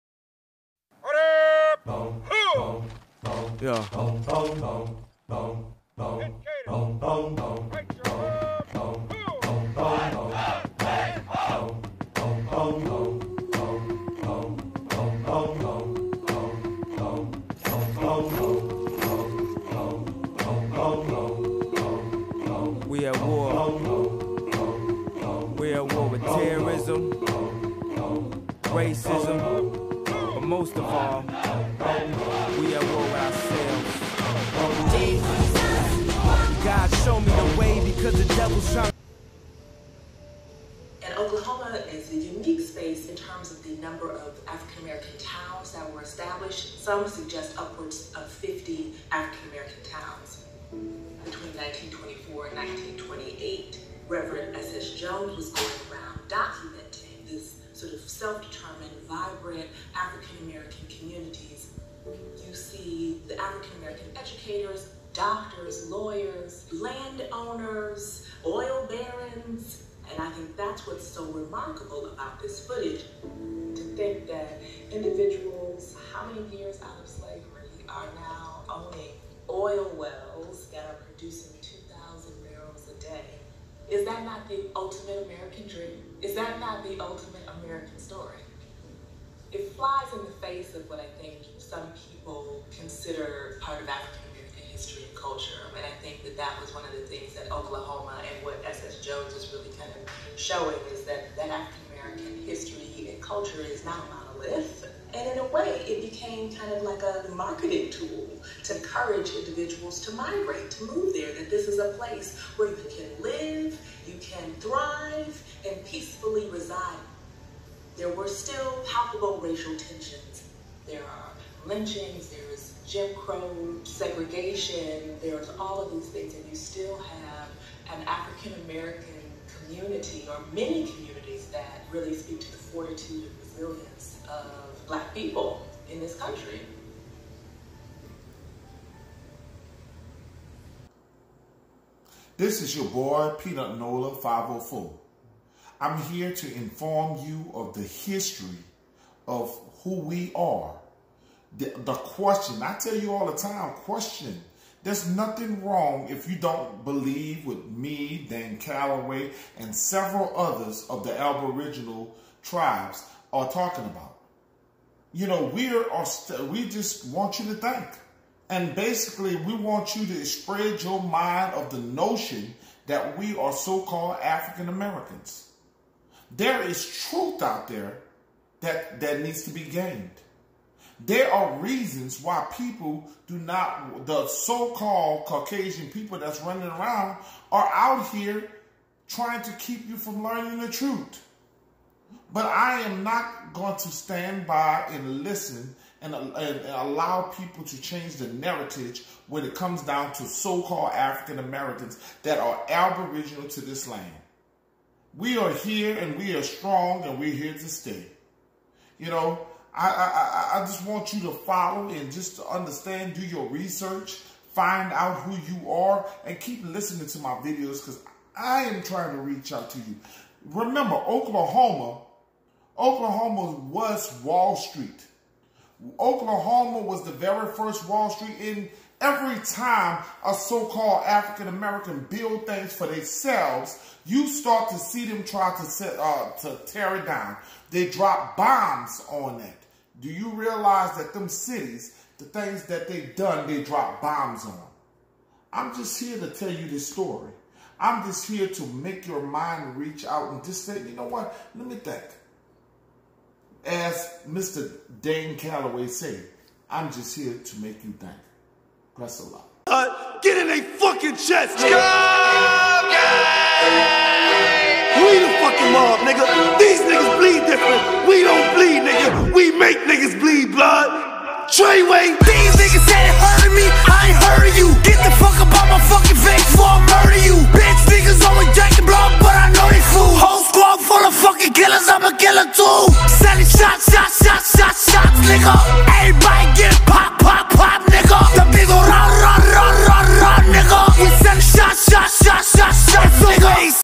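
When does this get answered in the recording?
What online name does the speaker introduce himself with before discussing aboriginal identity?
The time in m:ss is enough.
2:23.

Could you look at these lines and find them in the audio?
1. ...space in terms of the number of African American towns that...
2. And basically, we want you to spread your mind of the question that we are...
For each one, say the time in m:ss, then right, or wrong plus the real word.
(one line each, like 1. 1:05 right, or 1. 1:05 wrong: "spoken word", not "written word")
1. 0:42 right
2. 2:48 wrong: "notion", not "question".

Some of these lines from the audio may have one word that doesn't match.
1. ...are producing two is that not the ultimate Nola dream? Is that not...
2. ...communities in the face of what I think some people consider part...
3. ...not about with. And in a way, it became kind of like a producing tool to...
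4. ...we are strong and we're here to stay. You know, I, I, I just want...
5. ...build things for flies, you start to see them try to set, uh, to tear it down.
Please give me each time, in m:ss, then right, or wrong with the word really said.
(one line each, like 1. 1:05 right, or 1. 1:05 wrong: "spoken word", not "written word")
1. 1:20 wrong: "American", not "Nola"
2. 1:29 wrong: "flies", not "communities"
3. 1:43 wrong: "marketing", not "producing"
4. 3:26 right
5. 3:52 wrong: "themselves", not "flies".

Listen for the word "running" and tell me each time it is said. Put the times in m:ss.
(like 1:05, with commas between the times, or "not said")
3:06.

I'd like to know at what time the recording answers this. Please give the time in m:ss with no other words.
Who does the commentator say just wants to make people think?
4:14.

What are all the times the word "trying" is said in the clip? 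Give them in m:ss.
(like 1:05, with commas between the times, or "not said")
0:38, 3:09, 3:38.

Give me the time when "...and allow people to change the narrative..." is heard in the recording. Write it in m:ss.
3:16.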